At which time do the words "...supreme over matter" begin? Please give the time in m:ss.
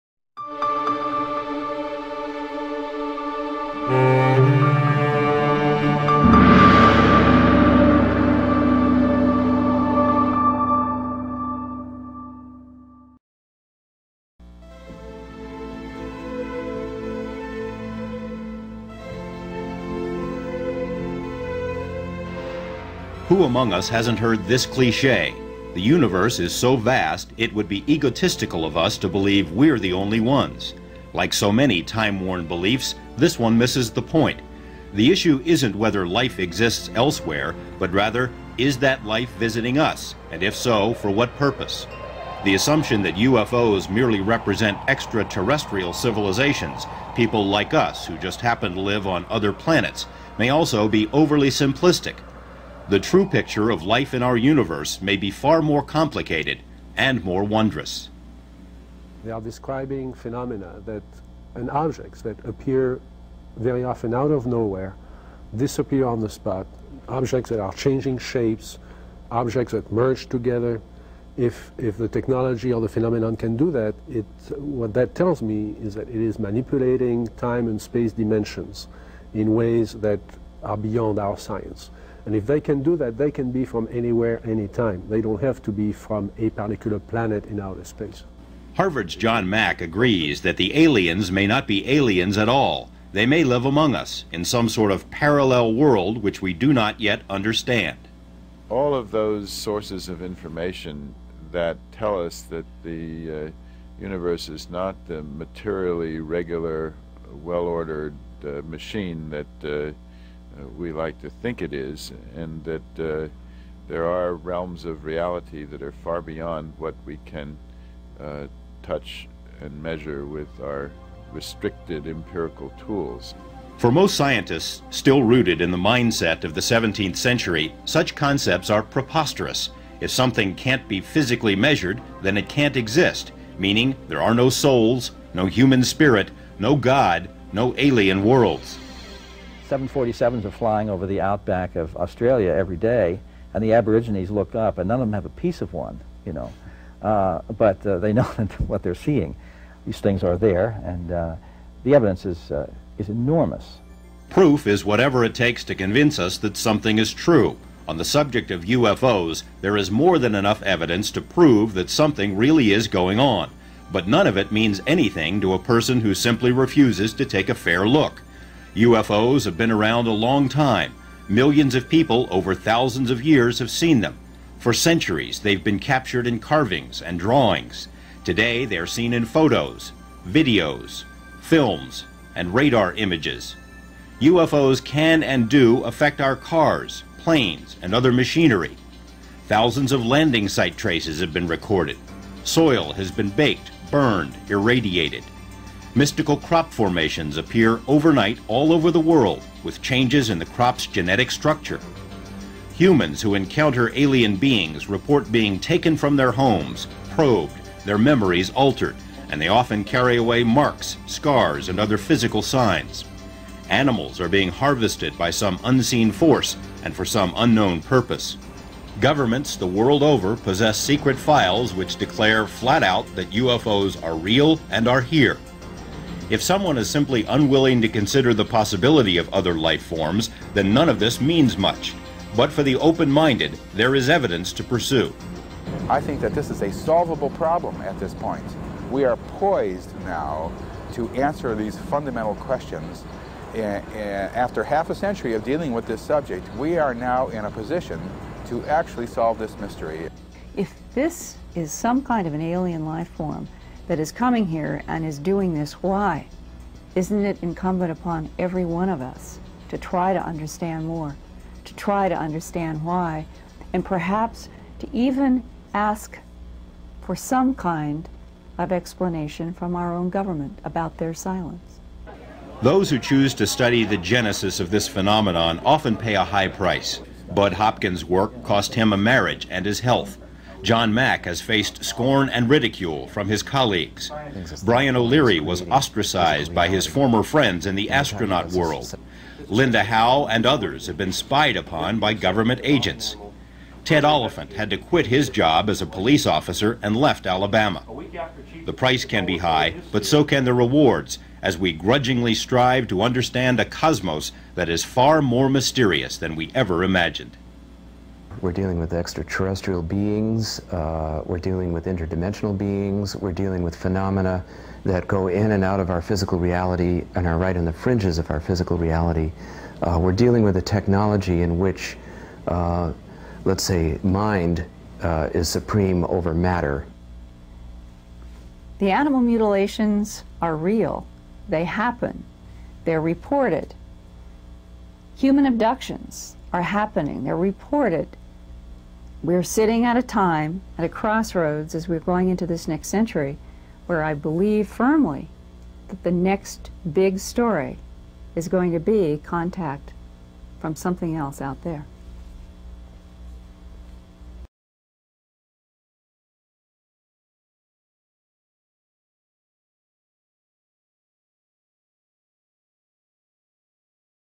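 5:25.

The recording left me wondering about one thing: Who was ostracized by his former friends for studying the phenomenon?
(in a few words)
Brian O'Leary.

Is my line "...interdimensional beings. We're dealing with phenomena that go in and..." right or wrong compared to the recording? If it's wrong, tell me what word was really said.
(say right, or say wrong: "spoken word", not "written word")
right.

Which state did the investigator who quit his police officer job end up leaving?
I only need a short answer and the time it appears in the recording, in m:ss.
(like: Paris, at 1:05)
Alabama, at 4:57.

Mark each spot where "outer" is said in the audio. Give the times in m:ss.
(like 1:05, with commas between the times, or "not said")
1:27.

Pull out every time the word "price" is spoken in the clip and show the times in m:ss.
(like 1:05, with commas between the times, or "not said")
4:36, 4:58.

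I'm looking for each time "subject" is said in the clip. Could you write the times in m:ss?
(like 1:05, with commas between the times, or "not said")
2:38, 4:06.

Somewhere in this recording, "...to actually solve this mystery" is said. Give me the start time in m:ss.
4:08.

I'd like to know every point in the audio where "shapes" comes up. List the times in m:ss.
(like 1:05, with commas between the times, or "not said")
1:08.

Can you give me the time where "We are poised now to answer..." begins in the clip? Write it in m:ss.
3:58.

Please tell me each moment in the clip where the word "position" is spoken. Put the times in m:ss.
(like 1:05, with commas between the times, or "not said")
4:07.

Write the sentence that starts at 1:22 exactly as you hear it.
And if they can do that, they can be from anywhere, anytime.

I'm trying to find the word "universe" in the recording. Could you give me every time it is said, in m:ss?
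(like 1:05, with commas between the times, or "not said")
0:25, 0:54, 1:43.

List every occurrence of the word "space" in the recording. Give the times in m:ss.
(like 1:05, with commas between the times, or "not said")
1:17, 1:27.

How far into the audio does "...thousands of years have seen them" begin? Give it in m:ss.
2:52.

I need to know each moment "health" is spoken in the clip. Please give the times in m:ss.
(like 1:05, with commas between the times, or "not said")
4:39.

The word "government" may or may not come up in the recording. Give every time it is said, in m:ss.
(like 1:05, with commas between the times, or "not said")
3:38, 4:30, 4:52.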